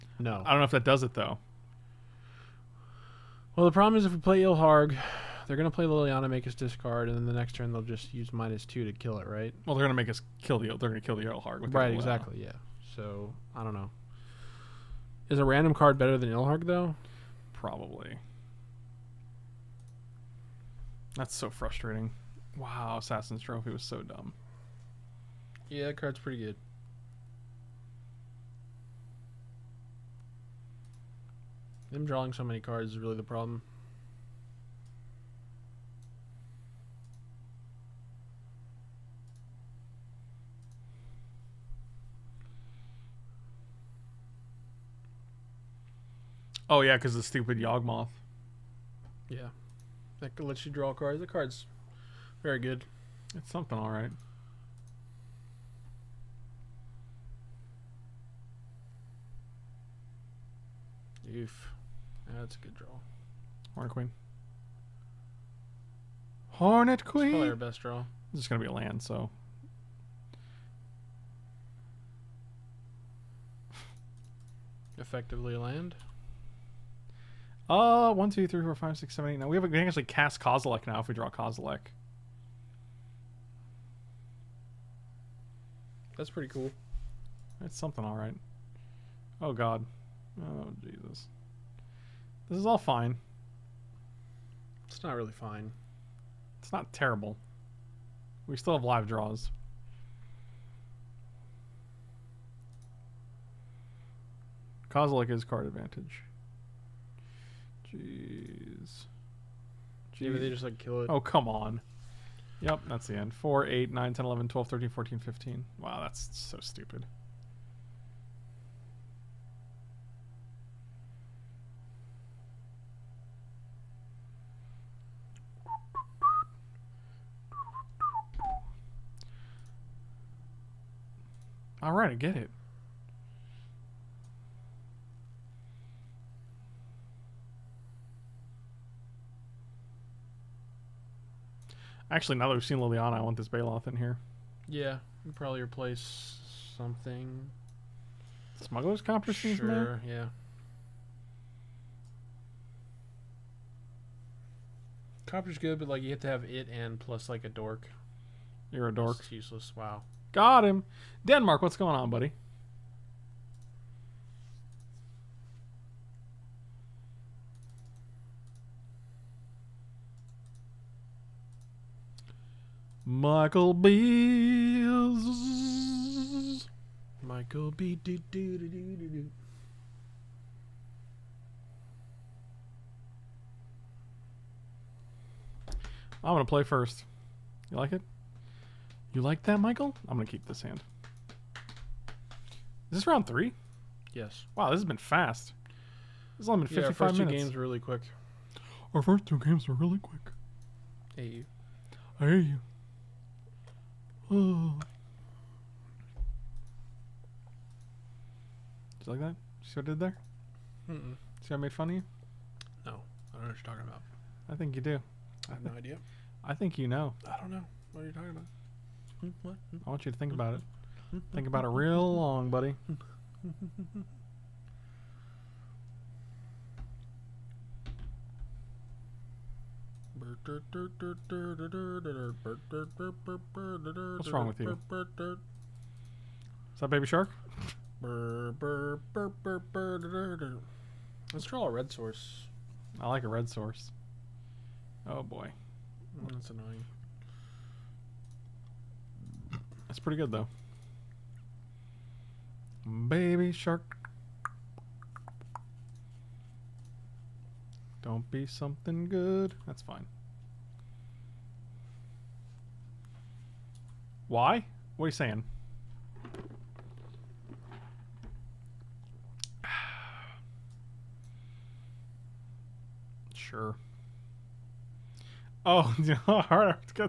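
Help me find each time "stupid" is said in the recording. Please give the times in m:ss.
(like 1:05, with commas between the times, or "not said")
0:47, 1:56.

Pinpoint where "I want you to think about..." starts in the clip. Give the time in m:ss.
3:39.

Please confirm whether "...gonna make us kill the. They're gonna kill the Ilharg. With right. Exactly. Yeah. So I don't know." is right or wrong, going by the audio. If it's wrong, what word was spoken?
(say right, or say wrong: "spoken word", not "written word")
right.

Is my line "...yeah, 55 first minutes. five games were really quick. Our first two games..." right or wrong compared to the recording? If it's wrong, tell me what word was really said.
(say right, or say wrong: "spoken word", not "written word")
wrong: "two", not "five".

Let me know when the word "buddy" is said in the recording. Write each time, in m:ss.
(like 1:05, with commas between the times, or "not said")
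2:42, 3:42.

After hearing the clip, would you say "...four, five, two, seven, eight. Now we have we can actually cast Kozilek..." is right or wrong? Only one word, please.
wrong.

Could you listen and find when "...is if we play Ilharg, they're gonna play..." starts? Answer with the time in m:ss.
0:03.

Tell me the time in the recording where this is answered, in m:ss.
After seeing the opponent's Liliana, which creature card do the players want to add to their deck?
2:23.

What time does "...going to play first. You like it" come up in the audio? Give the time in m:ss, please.
3:06.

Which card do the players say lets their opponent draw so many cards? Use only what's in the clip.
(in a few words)
Yawgmoth.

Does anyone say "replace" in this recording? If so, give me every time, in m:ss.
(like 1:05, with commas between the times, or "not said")
2:25.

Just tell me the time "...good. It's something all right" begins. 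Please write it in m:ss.
0:52.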